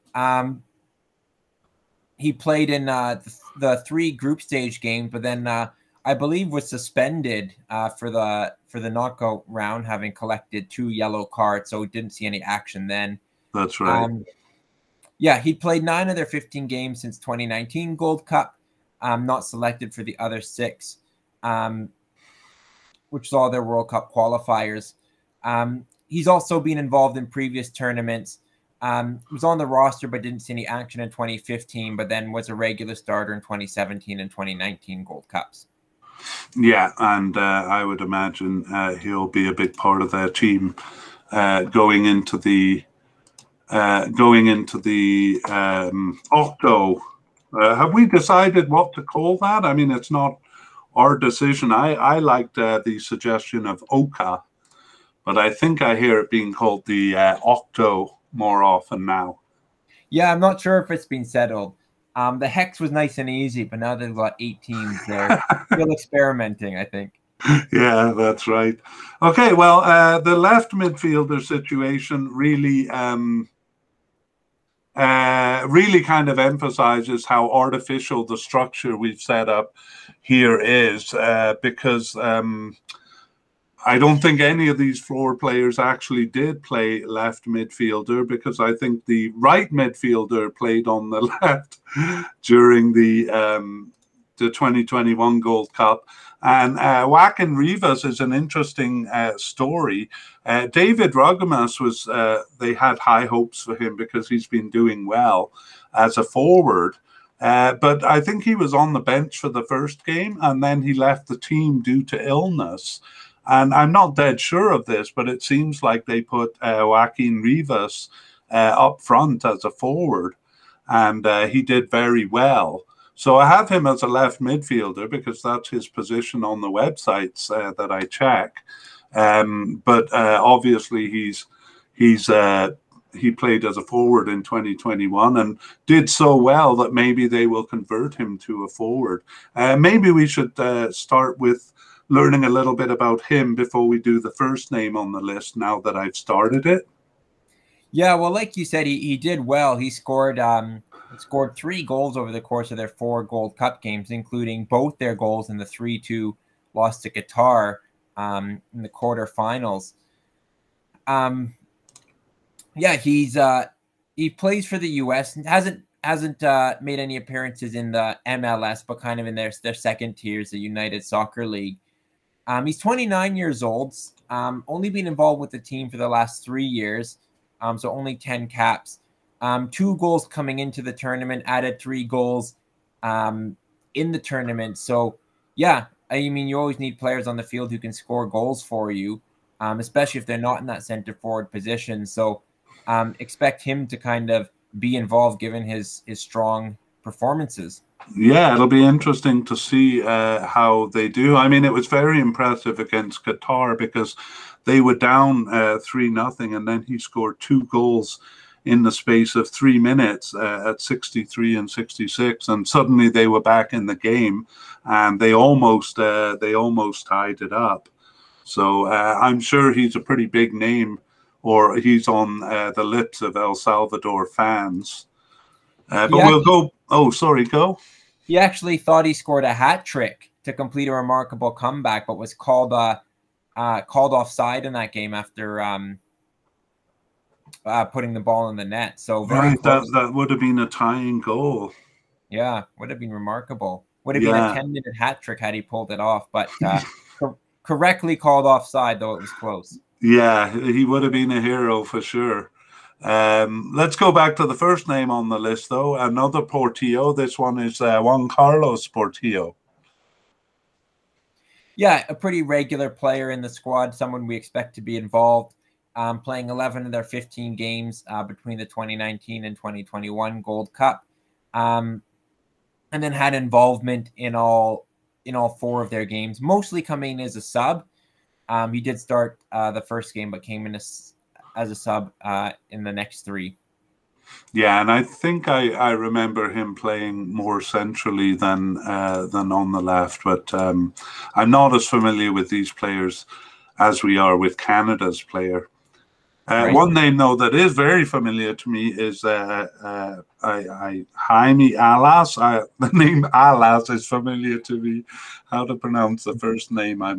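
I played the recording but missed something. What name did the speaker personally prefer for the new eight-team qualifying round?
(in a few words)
Oka.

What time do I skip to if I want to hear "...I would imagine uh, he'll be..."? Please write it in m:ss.
0:37.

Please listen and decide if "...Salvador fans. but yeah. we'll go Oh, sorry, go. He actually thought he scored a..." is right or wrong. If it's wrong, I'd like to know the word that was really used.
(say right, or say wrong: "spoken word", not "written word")
right.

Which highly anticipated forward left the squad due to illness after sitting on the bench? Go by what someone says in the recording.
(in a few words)
David Rugamas.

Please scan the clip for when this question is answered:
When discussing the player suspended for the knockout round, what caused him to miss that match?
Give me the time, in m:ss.
0:10.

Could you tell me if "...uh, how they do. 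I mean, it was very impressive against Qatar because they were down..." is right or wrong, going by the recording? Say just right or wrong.
right.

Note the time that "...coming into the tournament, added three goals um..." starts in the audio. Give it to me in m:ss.
3:00.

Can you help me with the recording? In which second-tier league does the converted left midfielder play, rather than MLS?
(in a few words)
United Soccer League.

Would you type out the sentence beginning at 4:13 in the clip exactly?
Um, let's go back to the first name on the list, though.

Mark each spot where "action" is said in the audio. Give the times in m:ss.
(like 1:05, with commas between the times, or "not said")
0:12, 0:30.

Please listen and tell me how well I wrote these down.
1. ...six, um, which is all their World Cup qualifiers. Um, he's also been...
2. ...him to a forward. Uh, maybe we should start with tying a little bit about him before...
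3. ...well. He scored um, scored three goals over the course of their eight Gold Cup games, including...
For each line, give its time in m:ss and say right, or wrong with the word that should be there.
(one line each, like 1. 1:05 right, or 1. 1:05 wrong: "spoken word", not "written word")
1. 0:20 right
2. 2:18 wrong: "learning", not "tying"
3. 2:29 wrong: "four", not "eight".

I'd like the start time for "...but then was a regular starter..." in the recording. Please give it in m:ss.
0:31.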